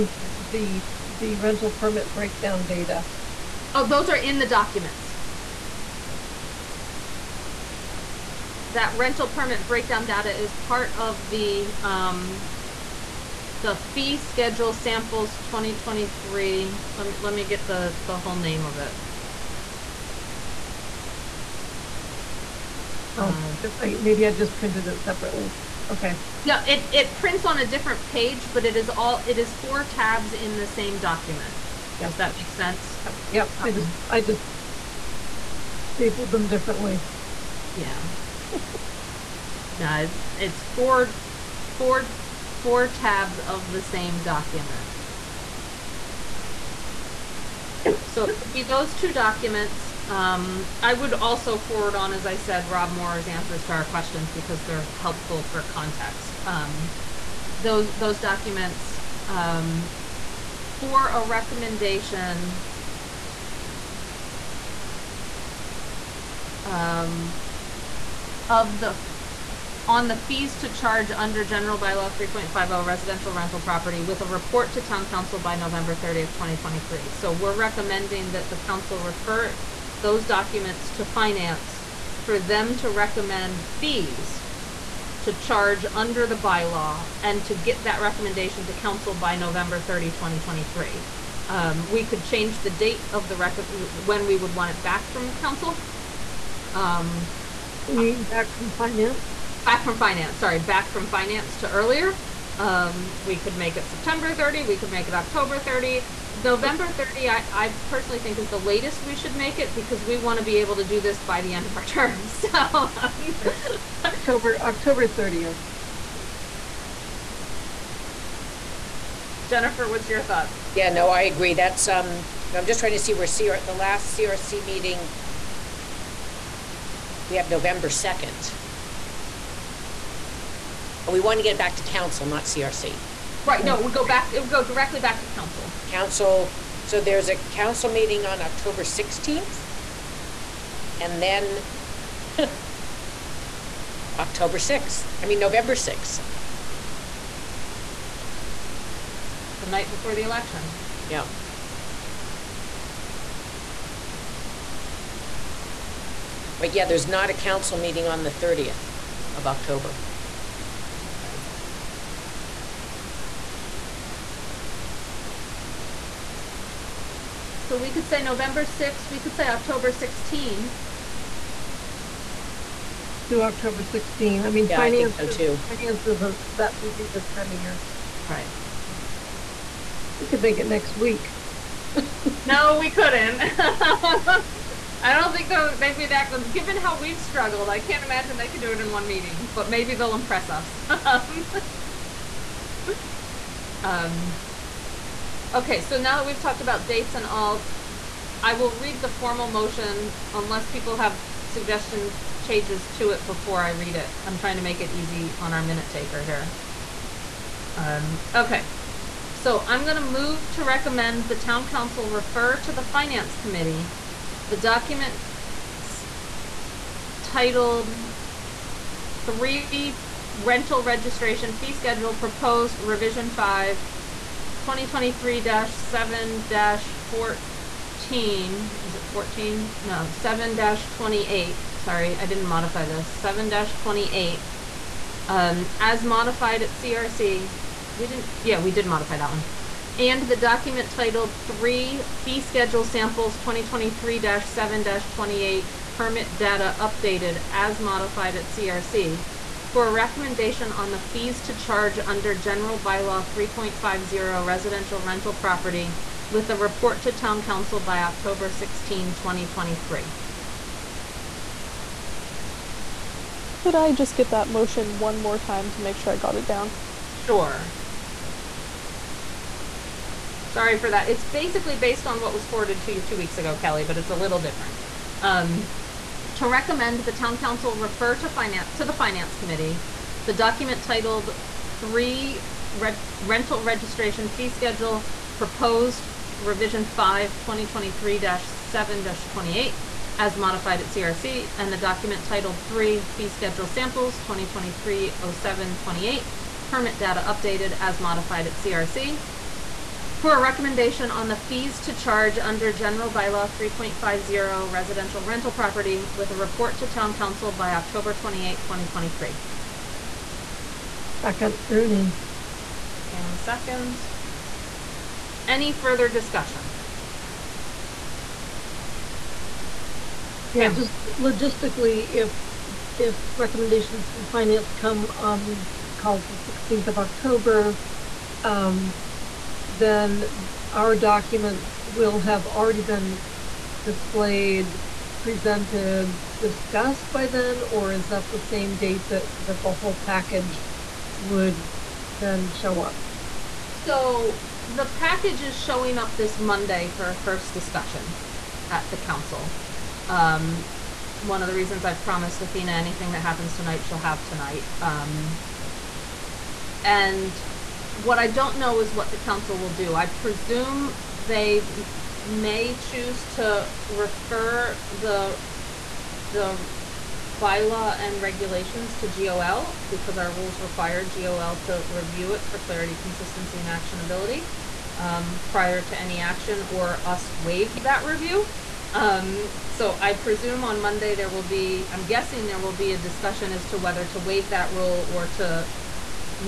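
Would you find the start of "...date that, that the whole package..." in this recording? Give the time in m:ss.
5:38.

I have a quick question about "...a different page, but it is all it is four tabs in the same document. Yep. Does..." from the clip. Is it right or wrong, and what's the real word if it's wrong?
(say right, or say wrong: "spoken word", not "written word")
right.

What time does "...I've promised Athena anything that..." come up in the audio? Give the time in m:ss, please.
5:51.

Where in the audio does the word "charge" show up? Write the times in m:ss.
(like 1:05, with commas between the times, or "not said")
1:10, 1:25, 4:11, 5:01.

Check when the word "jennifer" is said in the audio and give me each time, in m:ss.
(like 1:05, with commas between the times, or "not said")
1:59.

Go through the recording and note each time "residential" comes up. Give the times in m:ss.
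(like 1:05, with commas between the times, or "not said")
1:12, 4:14, 5:04.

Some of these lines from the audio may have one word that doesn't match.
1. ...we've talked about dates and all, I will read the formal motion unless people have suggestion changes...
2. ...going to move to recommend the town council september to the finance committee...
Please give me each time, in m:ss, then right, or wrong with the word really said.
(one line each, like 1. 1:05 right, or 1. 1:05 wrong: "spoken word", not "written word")
1. 3:16 right
2. 3:29 wrong: "refer", not "september".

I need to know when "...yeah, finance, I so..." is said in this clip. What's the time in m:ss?
2:54.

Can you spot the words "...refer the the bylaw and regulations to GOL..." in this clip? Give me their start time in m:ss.
6:03.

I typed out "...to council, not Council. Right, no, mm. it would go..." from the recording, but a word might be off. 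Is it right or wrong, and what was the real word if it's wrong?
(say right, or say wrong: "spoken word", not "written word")
wrong: "CRC", not "Council".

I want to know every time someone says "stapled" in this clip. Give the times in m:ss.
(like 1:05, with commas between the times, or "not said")
0:35.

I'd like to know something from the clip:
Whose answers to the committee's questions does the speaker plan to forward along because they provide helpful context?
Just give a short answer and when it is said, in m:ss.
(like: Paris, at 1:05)
Rob Morra, at 0:52.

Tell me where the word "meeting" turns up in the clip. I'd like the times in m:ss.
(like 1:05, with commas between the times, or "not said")
2:04, 2:17, 2:37, 3:09.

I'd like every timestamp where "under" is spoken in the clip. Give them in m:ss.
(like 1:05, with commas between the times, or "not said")
1:11, 1:25, 4:11, 5:02.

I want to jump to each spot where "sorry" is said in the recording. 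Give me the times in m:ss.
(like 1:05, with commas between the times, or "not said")
1:40, 3:51, 4:30.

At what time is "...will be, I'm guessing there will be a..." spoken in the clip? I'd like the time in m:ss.
6:21.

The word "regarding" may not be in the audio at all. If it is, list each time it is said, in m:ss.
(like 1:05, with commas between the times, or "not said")
not said.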